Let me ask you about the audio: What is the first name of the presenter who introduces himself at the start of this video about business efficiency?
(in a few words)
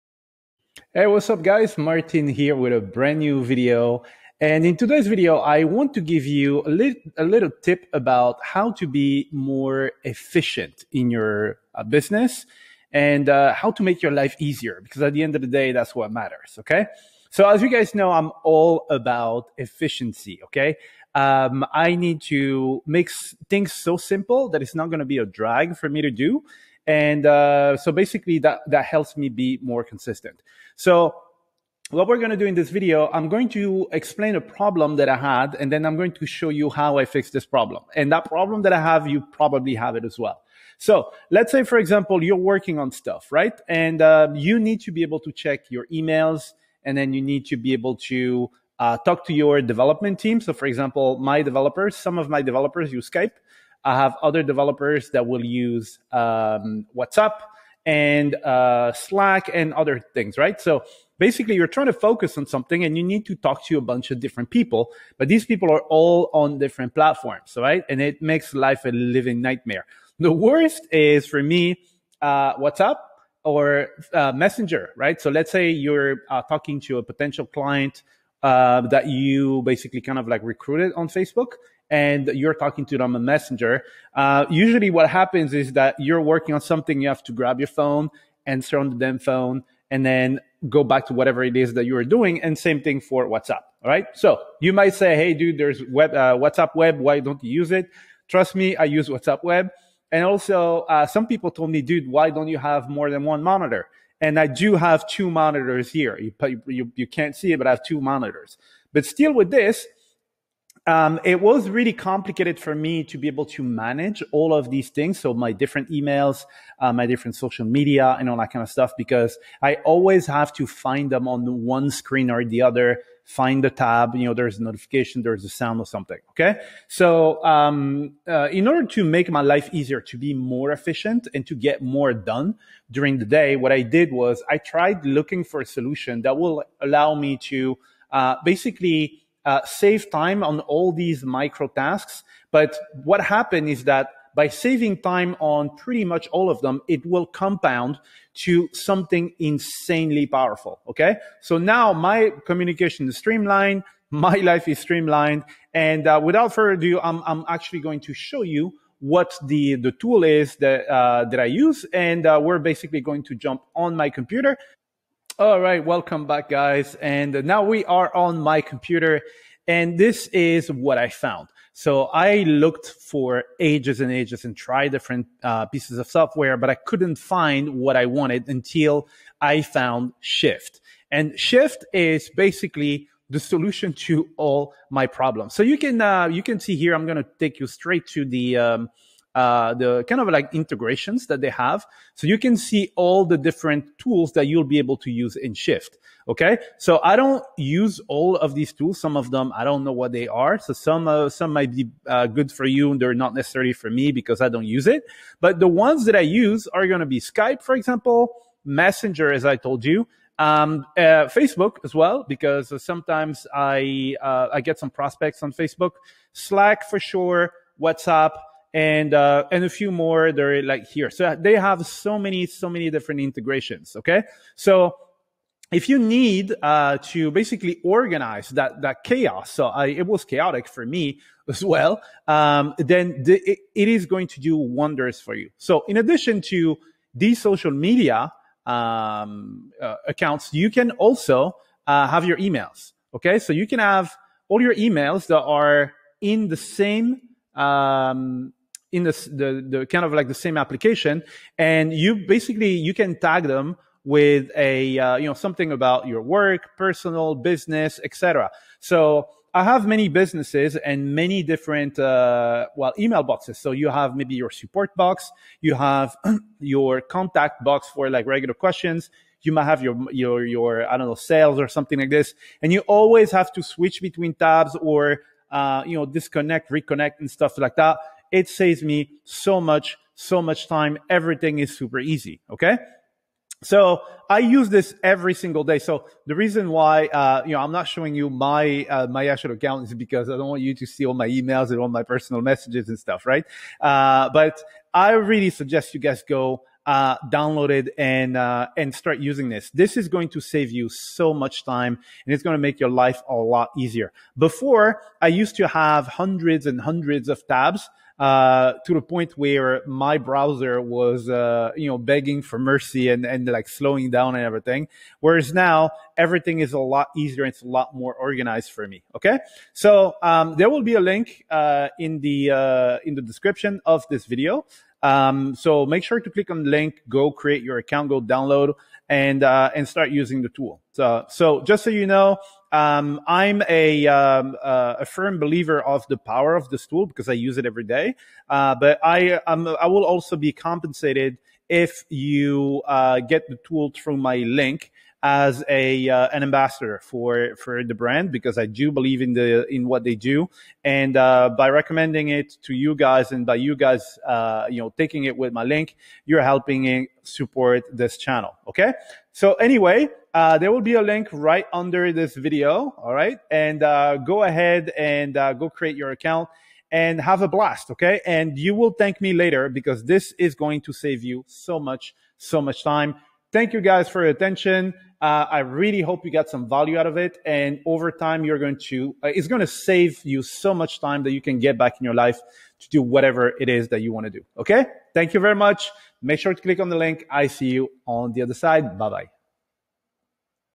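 Martin.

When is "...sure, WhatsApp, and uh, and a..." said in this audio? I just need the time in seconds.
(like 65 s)
216 s.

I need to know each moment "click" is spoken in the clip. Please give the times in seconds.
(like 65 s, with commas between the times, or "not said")
326 s, 386 s.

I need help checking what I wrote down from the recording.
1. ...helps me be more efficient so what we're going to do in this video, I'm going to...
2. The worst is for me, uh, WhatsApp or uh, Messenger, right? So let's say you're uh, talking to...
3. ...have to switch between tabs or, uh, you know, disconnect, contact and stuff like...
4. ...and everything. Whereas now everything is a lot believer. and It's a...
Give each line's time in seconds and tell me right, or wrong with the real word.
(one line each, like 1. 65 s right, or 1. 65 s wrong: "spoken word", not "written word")
1. 28 s wrong: "consistent", not "efficient"
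2. 70 s right
3. 273 s wrong: "reconnect", not "contact"
4. 314 s wrong: "easier", not "believer".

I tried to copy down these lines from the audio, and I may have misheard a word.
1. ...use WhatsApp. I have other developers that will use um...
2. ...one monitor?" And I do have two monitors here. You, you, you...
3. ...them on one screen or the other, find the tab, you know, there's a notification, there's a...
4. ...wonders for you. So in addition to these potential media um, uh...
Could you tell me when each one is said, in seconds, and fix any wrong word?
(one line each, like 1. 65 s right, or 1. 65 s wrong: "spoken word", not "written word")
1. 52 s wrong: "Skype", not "WhatsApp"
2. 103 s right
3. 121 s right
4. 234 s wrong: "social", not "potential".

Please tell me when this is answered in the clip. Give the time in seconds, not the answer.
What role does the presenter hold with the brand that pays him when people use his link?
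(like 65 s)
346 s.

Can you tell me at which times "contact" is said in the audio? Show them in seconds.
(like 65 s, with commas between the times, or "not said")
267 s.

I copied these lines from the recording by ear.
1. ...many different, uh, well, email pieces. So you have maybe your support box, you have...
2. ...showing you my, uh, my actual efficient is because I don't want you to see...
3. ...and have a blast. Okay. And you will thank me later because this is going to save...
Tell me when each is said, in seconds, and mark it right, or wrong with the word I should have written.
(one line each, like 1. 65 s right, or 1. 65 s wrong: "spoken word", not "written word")
1. 261 s wrong: "boxes", not "pieces"
2. 287 s wrong: "account", not "efficient"
3. 366 s right.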